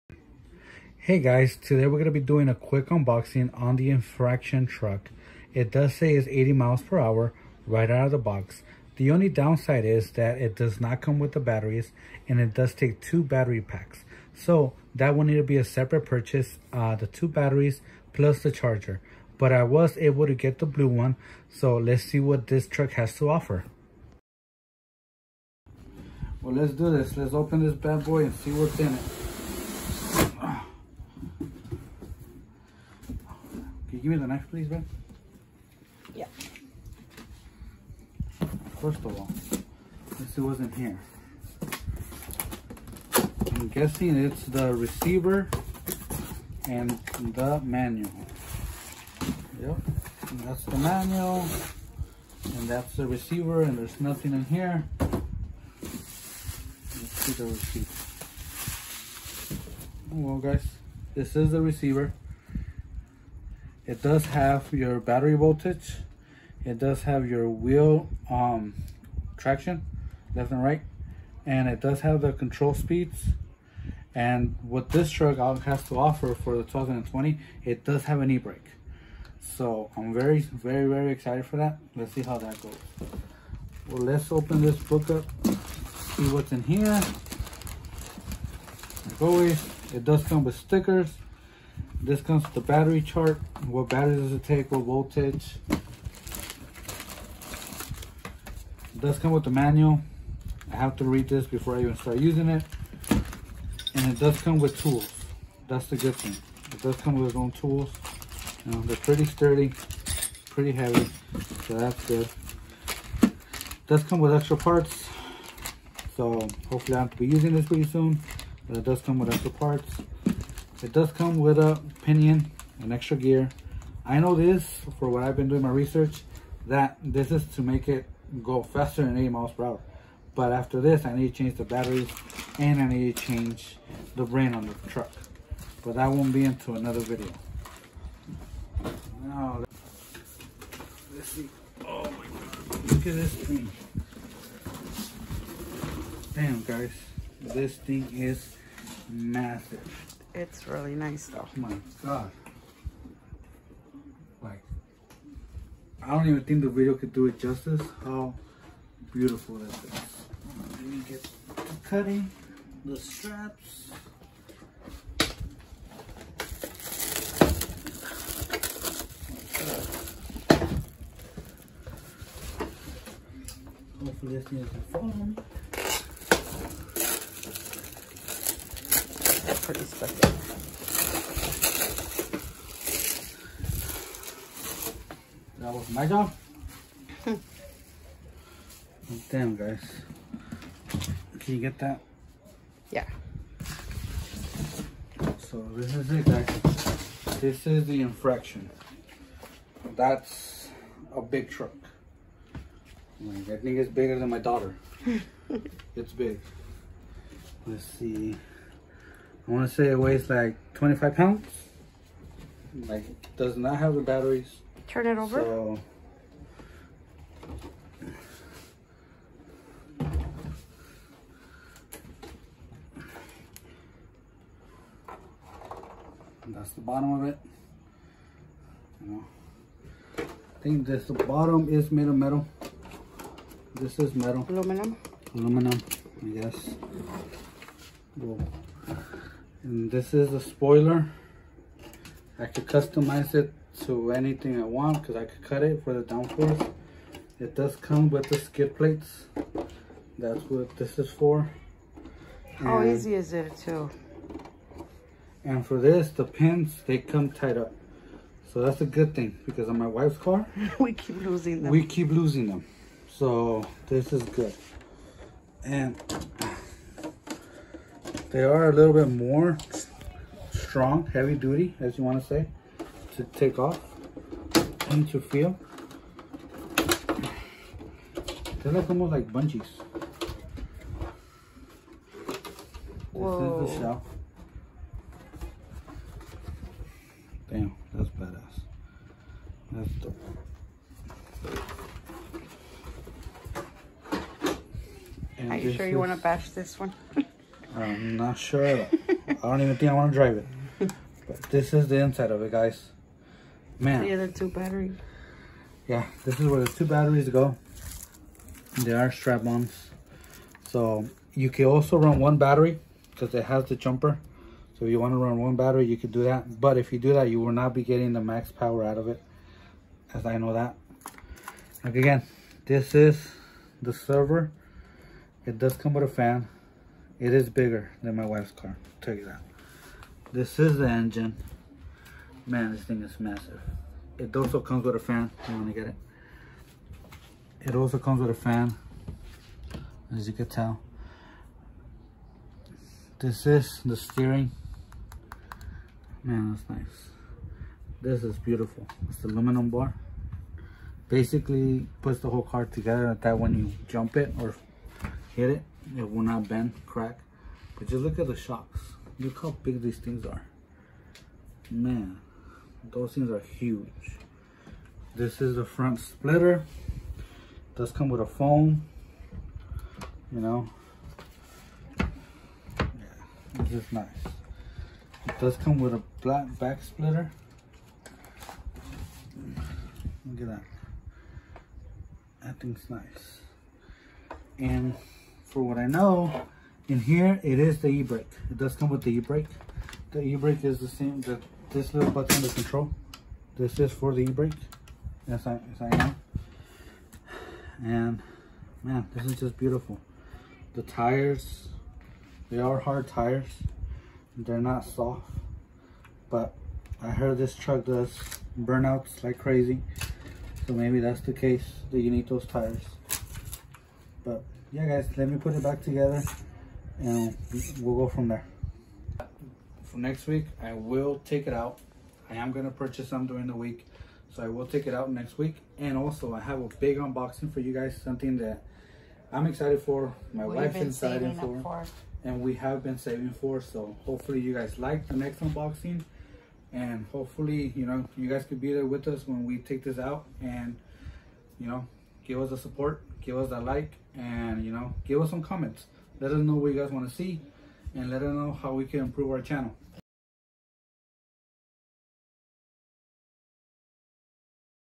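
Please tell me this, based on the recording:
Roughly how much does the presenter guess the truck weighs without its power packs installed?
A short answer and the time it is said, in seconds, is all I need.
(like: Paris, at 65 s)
25 pounds, at 210 s.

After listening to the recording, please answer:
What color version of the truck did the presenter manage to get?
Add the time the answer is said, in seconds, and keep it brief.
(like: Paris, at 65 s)
blue, at 20 s.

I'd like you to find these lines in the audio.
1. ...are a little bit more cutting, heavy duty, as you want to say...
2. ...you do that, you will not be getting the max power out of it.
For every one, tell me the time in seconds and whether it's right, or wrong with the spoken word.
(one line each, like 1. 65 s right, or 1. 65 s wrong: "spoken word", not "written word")
1. 268 s wrong: "strong", not "cutting"
2. 316 s right.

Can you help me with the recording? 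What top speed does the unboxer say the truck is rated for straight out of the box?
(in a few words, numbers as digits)
80 miles per hour.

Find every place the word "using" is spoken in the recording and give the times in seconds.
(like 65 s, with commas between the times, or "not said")
102 s, 117 s.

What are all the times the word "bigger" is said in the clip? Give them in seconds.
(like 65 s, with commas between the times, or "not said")
203 s, 327 s.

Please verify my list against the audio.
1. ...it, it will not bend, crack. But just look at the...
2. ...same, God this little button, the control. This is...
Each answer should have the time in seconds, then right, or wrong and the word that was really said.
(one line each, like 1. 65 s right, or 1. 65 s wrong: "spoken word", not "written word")
1. 355 s right
2. 390 s wrong: "That", not "God".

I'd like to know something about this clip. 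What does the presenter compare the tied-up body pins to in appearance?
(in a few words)
bungees.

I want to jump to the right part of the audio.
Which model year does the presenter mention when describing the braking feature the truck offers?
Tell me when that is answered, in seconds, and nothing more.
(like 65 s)
76 s.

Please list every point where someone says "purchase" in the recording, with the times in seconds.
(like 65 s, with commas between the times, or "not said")
16 s, 422 s.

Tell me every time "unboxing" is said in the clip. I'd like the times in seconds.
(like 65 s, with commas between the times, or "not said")
2 s, 426 s, 435 s.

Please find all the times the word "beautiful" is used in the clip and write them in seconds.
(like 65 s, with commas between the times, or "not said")
159 s, 348 s, 399 s.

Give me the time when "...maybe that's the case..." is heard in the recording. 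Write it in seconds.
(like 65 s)
410 s.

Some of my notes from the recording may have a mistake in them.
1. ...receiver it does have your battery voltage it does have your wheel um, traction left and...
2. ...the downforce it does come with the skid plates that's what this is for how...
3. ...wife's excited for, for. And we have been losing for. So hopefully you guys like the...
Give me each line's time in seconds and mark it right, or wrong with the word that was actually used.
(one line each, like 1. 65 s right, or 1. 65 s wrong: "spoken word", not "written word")
1. 61 s right
2. 245 s right
3. 430 s wrong: "saving", not "losing".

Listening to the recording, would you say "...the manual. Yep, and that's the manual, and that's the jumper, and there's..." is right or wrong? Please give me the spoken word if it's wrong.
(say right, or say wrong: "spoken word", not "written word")
wrong: "receiver", not "jumper".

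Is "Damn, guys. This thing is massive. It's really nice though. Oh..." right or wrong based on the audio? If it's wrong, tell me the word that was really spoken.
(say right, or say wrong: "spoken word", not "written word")
right.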